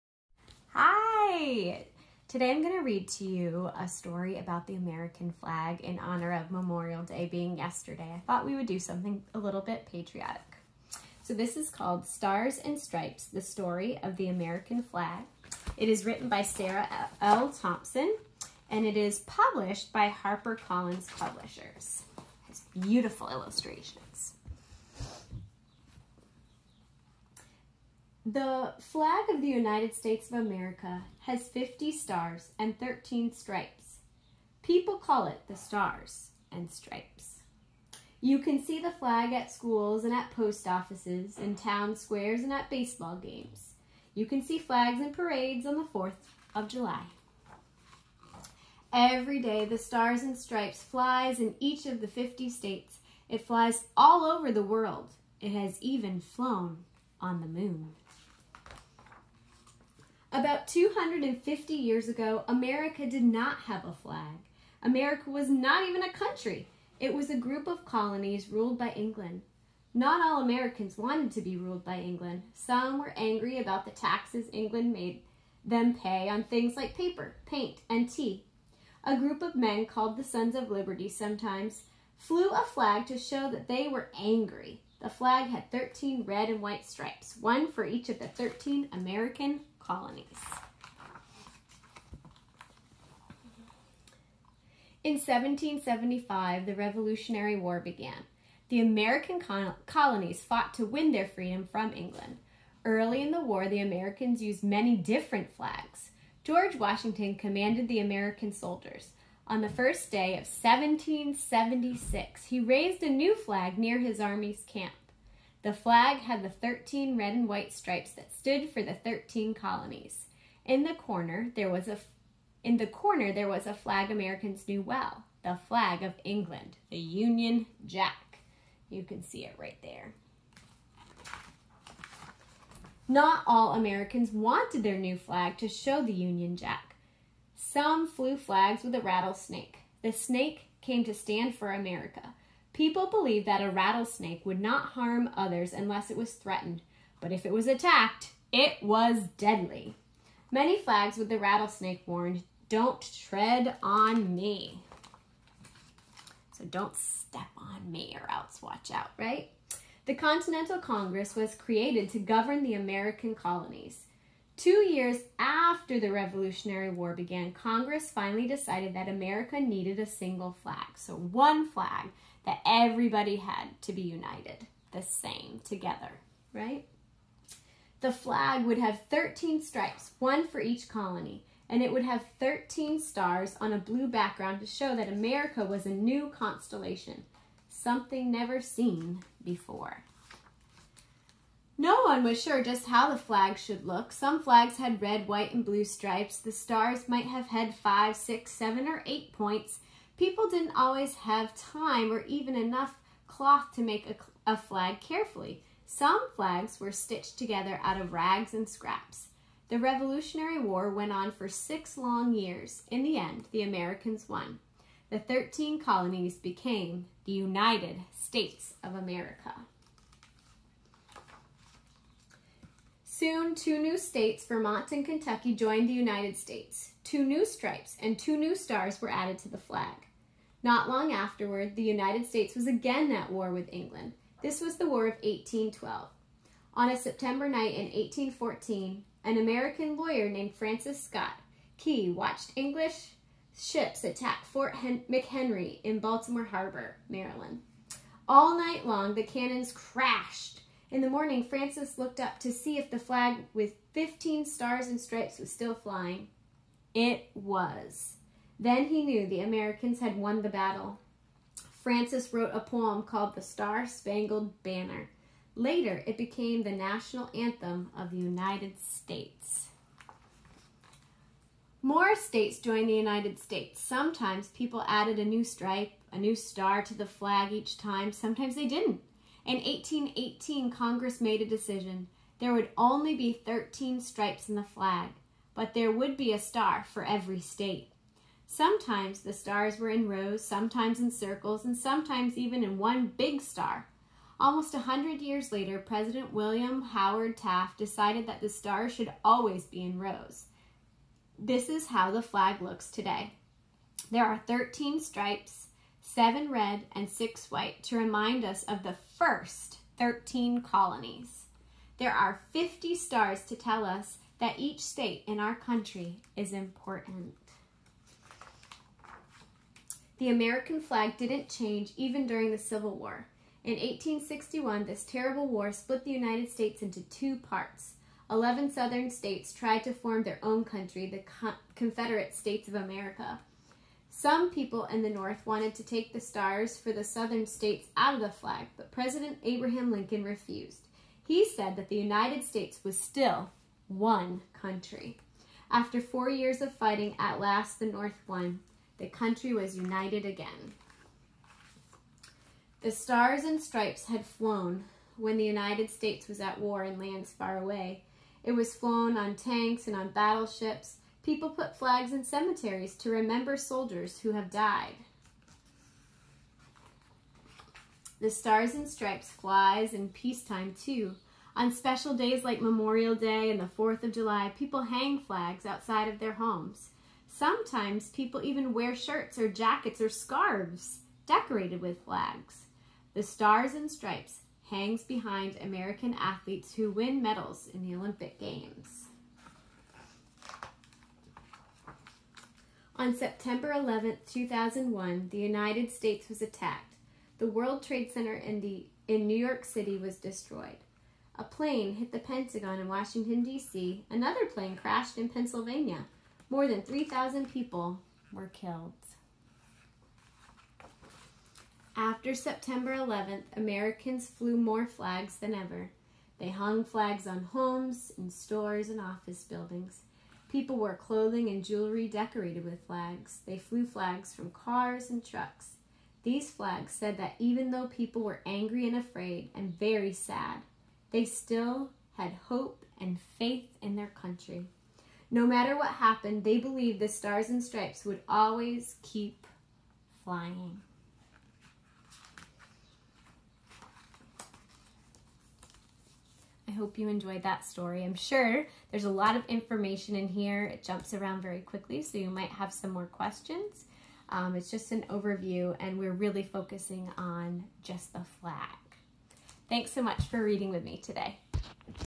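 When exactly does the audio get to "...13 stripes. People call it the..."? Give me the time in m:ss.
0:32.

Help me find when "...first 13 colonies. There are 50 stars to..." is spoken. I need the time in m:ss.
5:09.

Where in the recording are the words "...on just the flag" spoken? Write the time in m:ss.
7:37.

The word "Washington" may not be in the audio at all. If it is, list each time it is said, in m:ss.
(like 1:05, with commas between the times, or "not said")
1:46, 6:42.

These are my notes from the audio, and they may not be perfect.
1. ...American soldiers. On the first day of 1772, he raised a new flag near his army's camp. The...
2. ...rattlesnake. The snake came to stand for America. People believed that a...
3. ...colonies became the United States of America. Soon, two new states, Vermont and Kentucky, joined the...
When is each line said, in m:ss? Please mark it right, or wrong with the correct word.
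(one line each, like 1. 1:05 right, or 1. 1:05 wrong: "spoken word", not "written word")
1. 1:47 wrong: "1776", not "1772"
2. 2:18 right
3. 3:35 right.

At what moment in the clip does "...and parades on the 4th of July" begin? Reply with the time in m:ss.
0:45.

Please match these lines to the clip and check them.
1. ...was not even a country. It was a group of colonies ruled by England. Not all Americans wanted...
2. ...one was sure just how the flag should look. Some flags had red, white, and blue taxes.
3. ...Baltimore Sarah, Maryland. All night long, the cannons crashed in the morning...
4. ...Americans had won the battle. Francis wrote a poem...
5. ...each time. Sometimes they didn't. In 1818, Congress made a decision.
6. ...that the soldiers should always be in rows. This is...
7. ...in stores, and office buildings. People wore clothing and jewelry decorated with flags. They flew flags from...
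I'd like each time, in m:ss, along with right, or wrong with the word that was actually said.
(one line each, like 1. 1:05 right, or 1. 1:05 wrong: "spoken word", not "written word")
1. 1:05 right
2. 3:12 wrong: "stripes", not "taxes"
3. 4:05 wrong: "Harbor", not "Sarah"
4. 4:19 right
5. 4:37 right
6. 4:58 wrong: "stars", not "soldiers"
7. 6:58 right.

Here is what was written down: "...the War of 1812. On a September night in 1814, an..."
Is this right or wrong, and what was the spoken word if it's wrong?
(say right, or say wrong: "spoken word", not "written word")
right.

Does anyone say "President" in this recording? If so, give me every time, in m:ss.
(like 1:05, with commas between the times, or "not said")
4:55, 5:38.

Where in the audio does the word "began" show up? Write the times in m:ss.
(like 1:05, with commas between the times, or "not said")
1:37, 2:47.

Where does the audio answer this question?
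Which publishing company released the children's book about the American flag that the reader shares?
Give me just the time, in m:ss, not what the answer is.
0:20.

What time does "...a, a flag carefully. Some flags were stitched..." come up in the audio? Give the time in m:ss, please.
3:24.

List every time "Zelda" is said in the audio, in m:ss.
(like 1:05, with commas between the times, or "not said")
not said.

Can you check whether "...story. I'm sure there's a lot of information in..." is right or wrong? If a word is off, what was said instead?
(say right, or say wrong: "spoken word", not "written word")
right.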